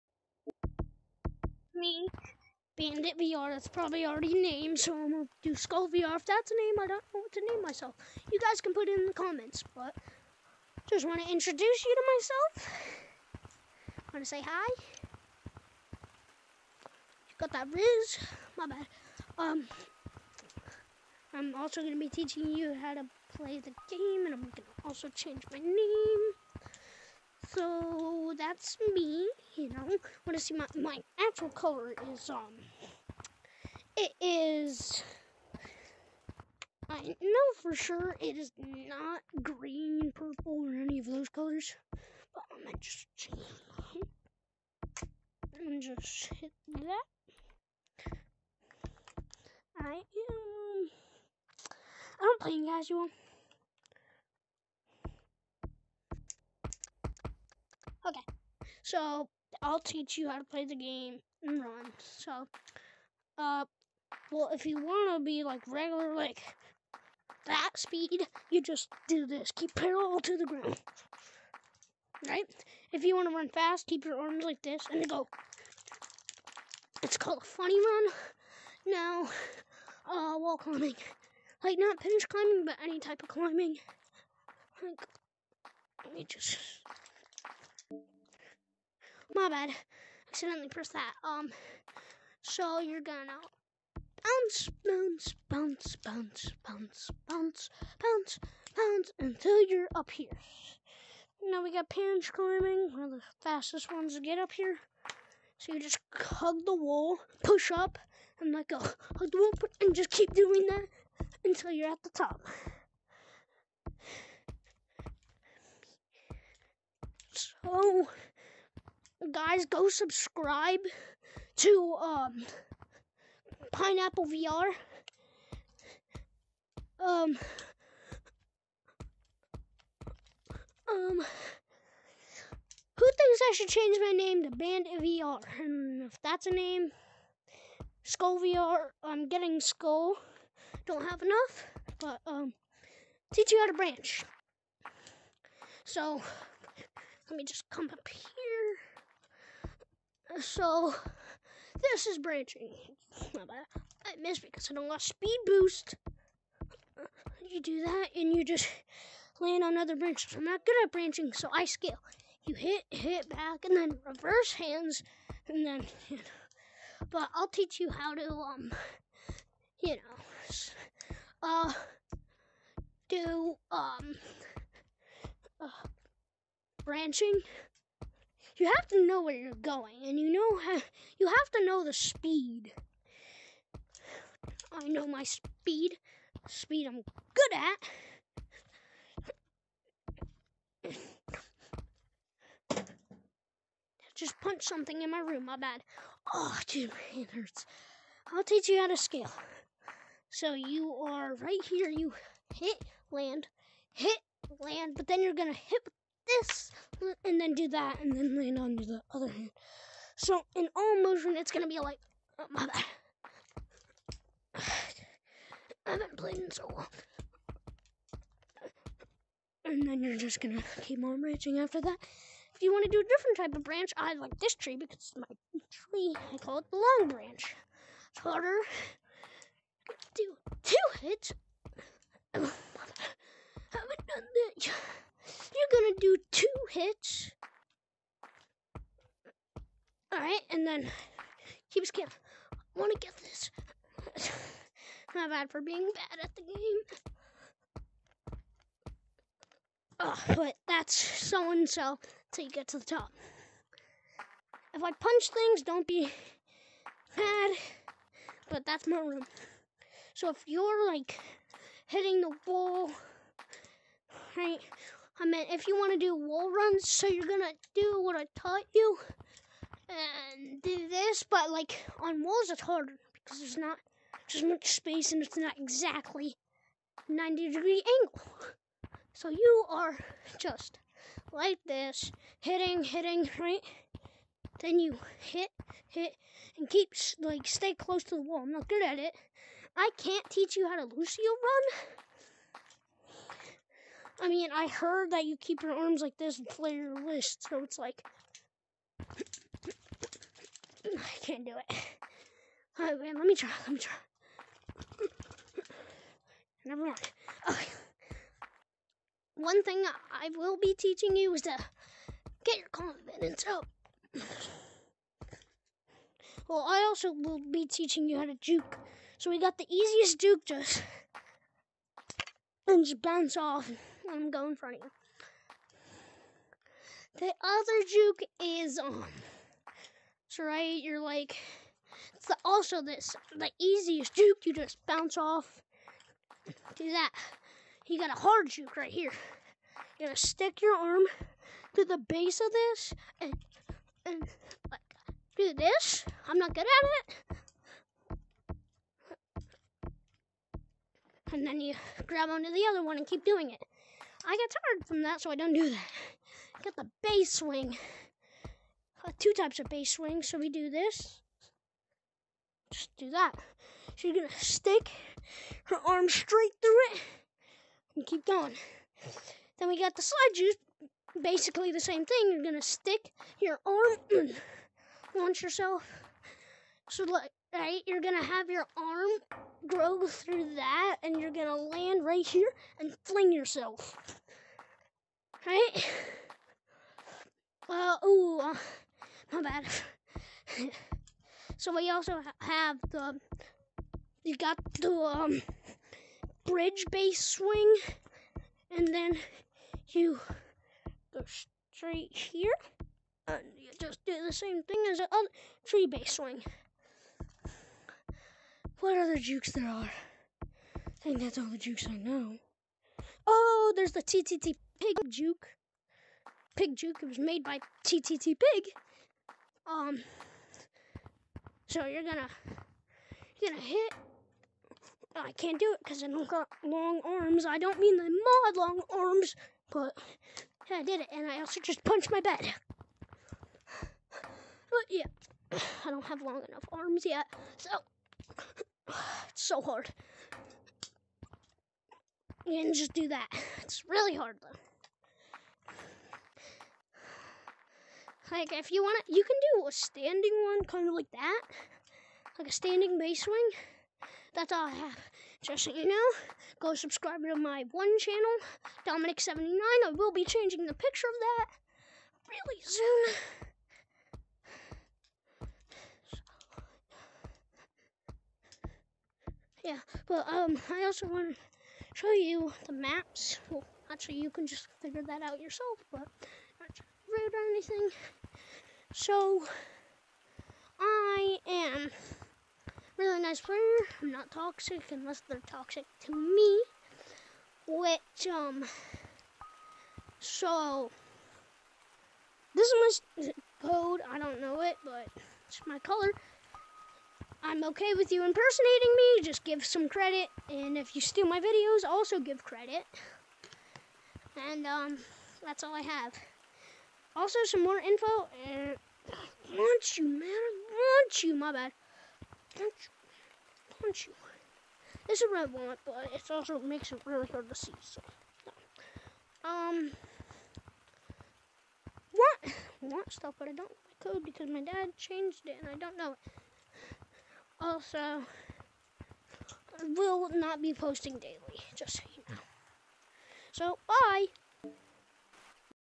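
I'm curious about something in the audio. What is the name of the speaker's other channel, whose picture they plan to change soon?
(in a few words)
Dominic79.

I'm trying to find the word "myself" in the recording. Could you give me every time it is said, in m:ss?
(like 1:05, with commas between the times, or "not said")
0:07, 0:12.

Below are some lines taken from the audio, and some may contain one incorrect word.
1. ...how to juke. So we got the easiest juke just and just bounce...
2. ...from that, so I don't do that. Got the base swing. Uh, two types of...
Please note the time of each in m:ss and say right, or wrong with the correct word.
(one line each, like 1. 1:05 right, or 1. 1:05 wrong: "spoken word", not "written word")
1. 5:18 right
2. 5:54 right.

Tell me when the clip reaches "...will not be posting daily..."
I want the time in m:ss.
8:49.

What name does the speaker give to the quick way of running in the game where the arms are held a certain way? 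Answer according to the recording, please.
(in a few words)
funny run.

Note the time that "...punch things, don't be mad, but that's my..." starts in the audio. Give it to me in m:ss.
4:14.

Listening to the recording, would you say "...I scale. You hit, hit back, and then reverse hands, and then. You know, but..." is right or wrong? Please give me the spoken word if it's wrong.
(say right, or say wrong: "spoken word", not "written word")
right.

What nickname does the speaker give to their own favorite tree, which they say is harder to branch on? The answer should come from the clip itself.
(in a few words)
the long branch.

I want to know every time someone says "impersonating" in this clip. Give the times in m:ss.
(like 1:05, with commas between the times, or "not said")
8:18.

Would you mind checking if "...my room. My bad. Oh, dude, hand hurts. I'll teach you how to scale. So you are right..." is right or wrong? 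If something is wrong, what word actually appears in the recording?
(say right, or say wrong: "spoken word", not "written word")
right.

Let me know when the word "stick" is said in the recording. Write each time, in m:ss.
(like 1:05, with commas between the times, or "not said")
5:40, 6:04, 6:12.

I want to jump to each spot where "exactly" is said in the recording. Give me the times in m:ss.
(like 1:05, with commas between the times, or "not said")
4:35.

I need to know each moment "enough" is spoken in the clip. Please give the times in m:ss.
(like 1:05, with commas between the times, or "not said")
2:21, 7:16.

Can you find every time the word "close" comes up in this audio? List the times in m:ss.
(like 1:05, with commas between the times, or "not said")
4:47.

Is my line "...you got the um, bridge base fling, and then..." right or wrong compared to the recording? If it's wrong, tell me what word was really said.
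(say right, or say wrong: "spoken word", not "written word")
wrong: "swing", not "fling".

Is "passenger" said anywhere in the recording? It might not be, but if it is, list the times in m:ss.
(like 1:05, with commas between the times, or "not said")
not said.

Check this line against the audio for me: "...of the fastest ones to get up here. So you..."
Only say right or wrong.
right.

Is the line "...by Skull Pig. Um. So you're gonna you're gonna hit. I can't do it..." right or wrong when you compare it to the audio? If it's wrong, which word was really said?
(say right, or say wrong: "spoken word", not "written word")
wrong: "TTT", not "Skull".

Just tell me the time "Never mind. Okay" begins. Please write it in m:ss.
5:06.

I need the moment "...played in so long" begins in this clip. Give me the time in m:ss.
3:36.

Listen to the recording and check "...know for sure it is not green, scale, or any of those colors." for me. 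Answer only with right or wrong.
wrong.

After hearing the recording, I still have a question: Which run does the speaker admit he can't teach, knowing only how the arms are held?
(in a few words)
Lucio run.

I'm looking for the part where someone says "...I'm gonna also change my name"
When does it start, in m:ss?
0:24.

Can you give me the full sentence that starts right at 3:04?
I know my speed, speed I'm good at.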